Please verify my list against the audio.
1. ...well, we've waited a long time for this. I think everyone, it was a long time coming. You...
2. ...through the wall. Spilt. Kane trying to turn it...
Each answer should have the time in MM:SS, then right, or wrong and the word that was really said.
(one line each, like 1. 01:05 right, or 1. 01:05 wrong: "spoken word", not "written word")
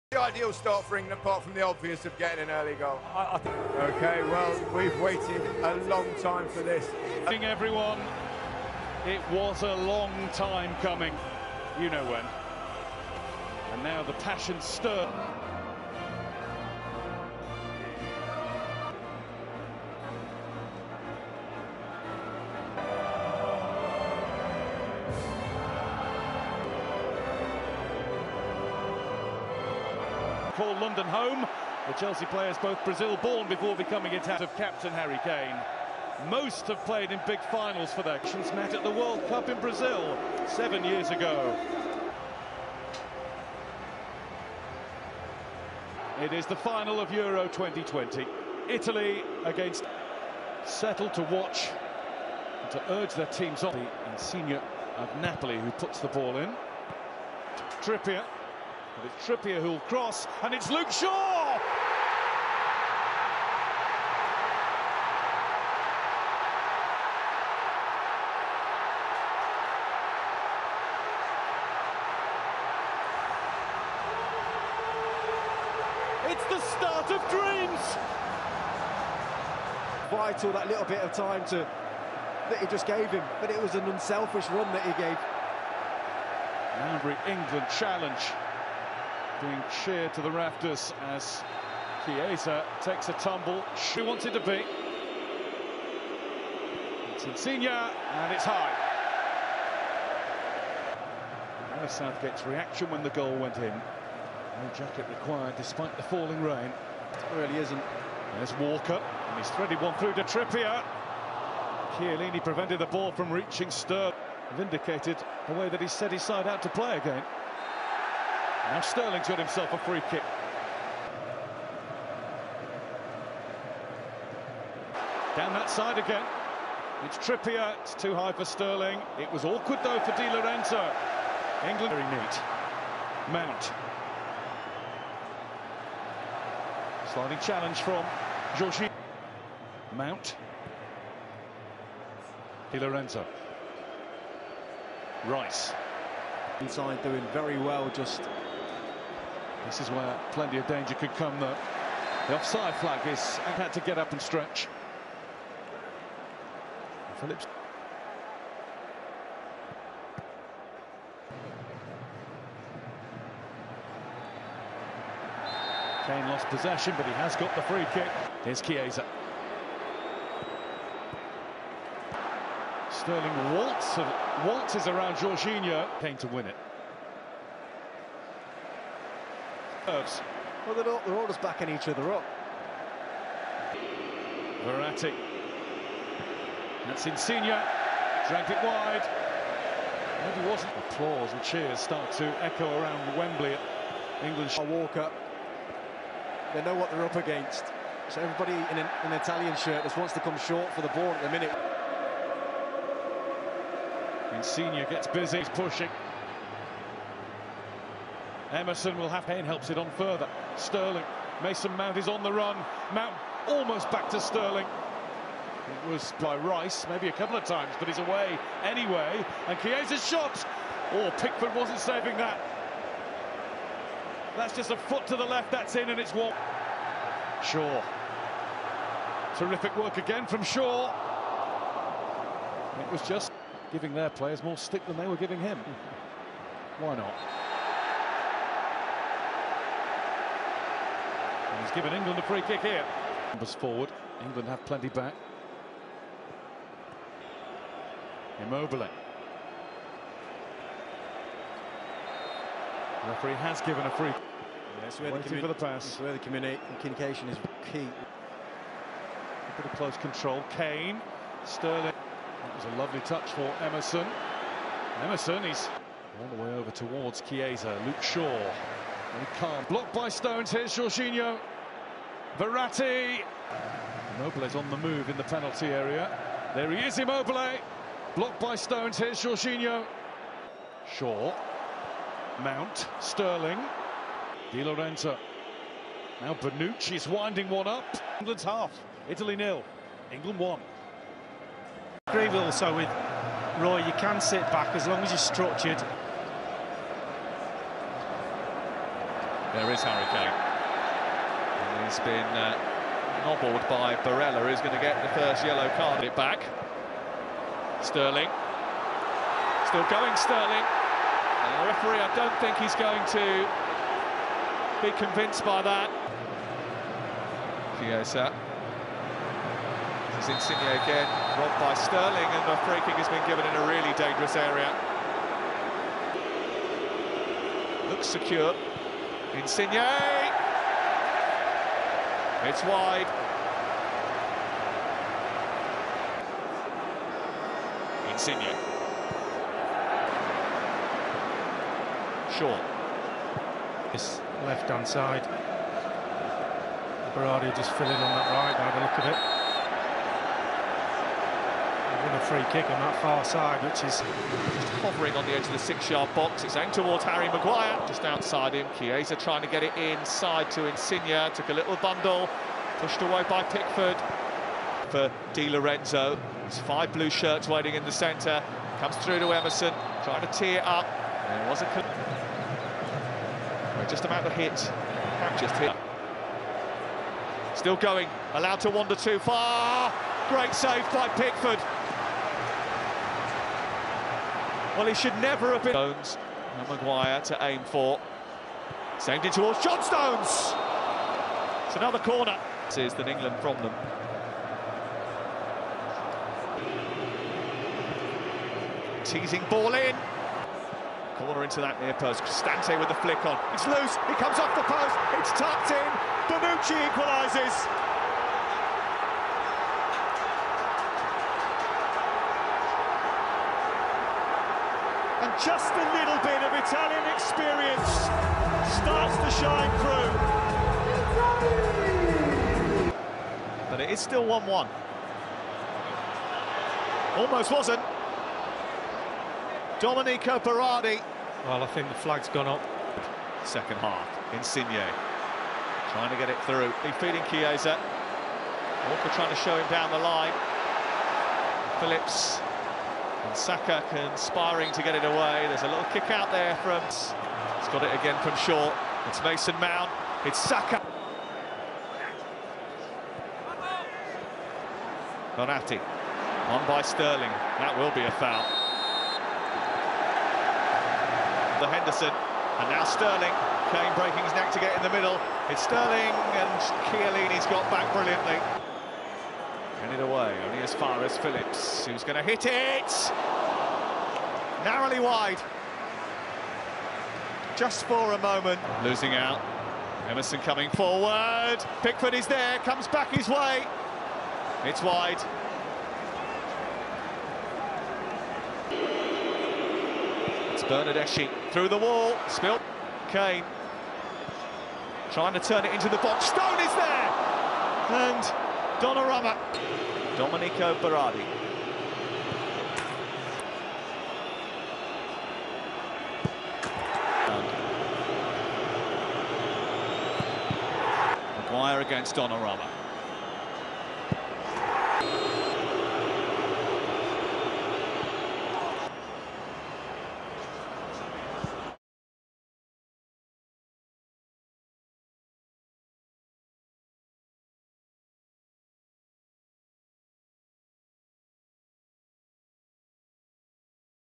1. 00:04 right
2. 08:11 right.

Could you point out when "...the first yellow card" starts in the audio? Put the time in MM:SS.
05:05.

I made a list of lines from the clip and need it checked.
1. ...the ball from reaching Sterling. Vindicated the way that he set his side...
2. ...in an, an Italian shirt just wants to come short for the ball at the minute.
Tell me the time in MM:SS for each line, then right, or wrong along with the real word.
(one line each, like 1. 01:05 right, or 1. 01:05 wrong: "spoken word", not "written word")
1. 01:52 right
2. 03:18 right.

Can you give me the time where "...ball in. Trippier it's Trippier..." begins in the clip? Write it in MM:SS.
00:56.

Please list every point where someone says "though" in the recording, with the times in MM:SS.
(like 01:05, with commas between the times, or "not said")
02:09, 02:31.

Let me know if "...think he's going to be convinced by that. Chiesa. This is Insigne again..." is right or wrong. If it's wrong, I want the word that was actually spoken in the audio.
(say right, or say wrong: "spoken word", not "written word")
right.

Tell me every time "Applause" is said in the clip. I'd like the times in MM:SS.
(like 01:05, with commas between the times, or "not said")
03:10.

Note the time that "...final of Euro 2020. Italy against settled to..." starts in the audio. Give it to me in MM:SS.
00:46.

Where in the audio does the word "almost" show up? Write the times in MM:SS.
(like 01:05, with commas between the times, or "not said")
03:33, 07:07.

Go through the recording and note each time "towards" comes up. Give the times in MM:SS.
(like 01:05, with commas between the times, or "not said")
04:26, 05:56, 06:29.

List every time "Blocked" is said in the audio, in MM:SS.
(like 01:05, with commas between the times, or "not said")
04:29, 04:38.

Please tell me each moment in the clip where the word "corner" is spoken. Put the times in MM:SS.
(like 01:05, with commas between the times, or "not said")
06:31, 06:41.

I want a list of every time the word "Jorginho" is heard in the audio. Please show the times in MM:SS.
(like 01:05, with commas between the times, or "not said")
02:55, 04:30, 04:39.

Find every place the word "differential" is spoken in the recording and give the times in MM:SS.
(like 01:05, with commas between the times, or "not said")
not said.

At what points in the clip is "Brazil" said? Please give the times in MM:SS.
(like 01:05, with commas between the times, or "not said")
00:32, 00:39.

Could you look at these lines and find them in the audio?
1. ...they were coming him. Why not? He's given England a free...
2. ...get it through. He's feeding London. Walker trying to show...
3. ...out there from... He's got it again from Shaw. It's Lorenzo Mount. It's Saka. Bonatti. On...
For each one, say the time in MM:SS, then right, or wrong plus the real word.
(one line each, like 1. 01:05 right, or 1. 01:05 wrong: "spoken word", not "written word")
1. 03:54 wrong: "giving", not "coming"
2. 07:16 wrong: "Chiesa", not "London"
3. 07:26 wrong: "Mason", not "Lorenzo".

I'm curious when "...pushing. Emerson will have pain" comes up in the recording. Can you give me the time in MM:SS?
03:25.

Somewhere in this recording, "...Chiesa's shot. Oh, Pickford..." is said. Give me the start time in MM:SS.
03:39.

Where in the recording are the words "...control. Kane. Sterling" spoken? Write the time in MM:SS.
04:19.